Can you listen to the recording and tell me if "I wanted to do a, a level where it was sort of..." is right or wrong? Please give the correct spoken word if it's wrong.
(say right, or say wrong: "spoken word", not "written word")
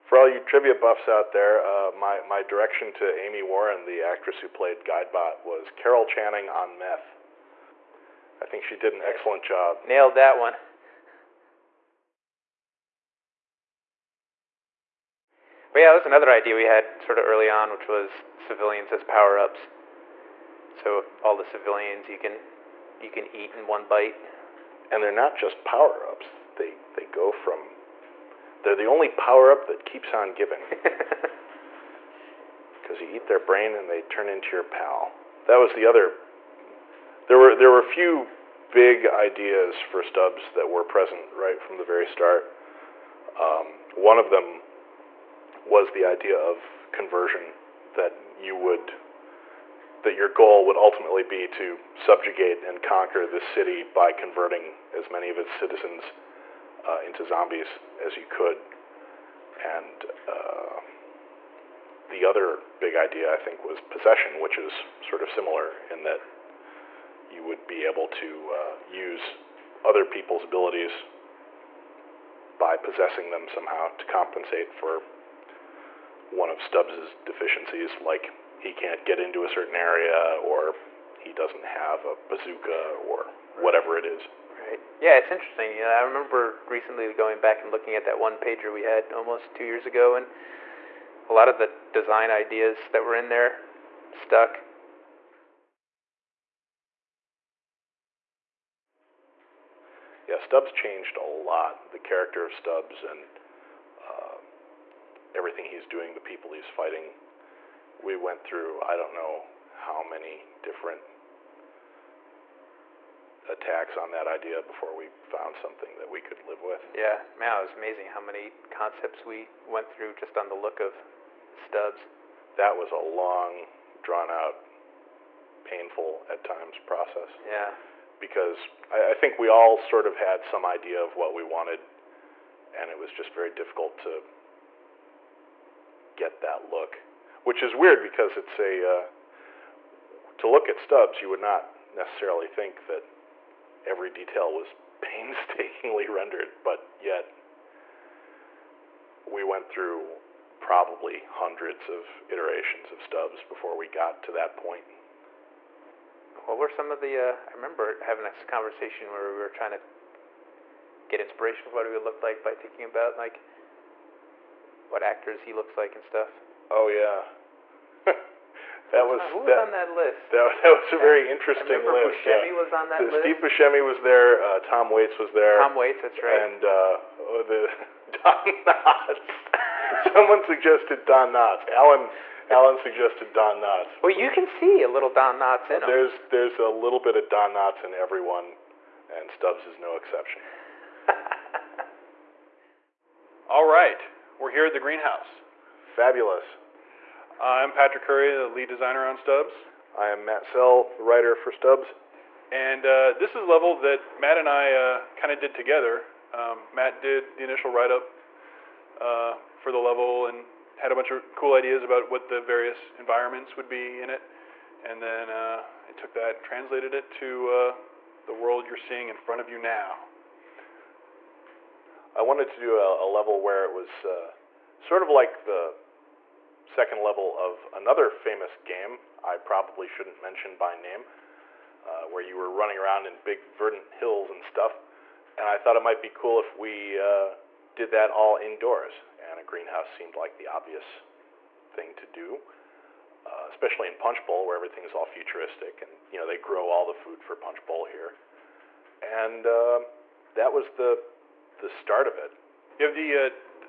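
right.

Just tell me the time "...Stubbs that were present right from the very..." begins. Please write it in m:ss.
0:40.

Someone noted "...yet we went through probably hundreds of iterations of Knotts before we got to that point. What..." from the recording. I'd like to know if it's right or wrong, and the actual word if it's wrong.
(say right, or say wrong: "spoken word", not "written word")
wrong: "Stubbs", not "Knotts".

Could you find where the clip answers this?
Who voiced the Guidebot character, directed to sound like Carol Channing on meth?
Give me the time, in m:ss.
0:03.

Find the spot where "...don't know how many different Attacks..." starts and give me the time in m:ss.
1:48.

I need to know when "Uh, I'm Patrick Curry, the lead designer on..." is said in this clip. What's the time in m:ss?
3:17.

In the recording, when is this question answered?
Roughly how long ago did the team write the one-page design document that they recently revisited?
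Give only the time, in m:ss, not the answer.
1:29.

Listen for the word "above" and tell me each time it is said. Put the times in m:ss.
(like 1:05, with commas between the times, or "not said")
not said.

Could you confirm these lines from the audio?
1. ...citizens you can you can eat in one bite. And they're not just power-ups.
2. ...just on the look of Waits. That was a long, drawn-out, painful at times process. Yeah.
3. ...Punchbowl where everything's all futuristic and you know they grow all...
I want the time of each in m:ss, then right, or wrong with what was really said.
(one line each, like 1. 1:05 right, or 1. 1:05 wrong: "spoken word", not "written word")
1. 0:21 wrong: "civilians", not "citizens"
2. 2:00 wrong: "Stubbs", not "Waits"
3. 4:03 right.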